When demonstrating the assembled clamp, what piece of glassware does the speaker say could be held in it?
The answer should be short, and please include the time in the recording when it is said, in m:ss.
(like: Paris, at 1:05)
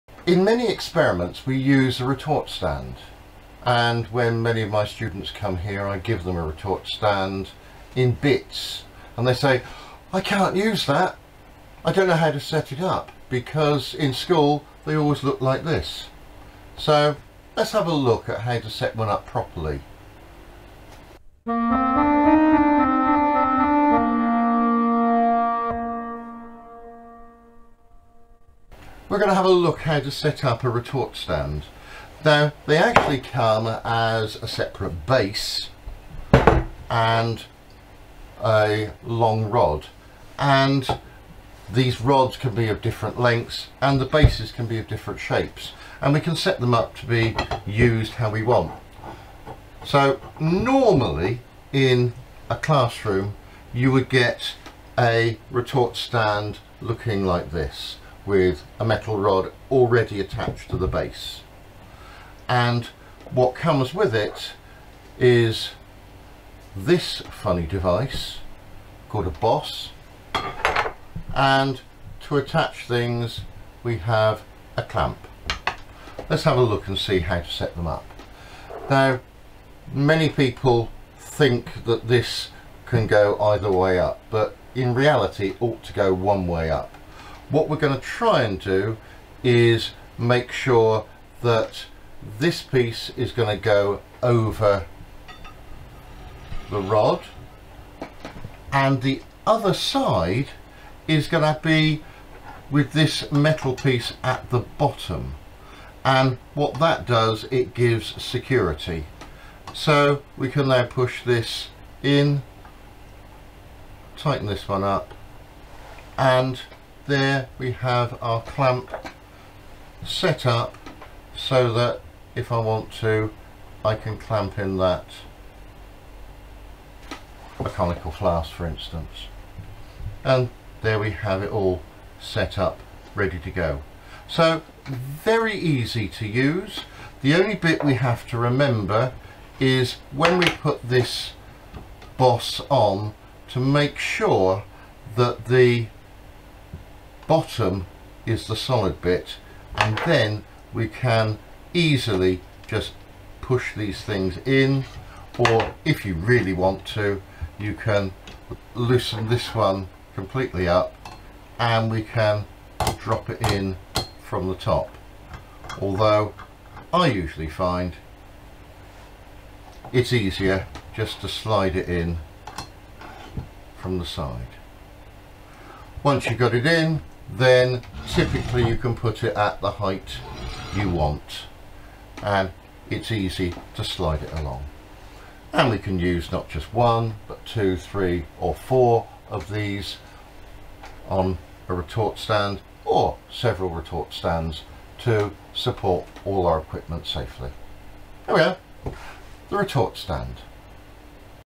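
conical flask, at 2:07.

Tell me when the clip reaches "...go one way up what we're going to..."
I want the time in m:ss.
1:25.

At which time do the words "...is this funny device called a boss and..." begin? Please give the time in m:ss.
1:05.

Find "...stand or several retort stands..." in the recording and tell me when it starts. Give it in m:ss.
3:12.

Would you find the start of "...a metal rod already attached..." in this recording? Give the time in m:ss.
0:58.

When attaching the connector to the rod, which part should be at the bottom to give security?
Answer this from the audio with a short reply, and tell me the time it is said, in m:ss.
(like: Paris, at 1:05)
the solid bit, at 2:28.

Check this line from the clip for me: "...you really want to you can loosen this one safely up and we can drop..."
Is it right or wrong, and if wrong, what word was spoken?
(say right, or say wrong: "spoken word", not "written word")
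wrong: "completely", not "safely".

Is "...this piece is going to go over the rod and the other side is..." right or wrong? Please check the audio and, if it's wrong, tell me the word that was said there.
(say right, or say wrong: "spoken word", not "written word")
right.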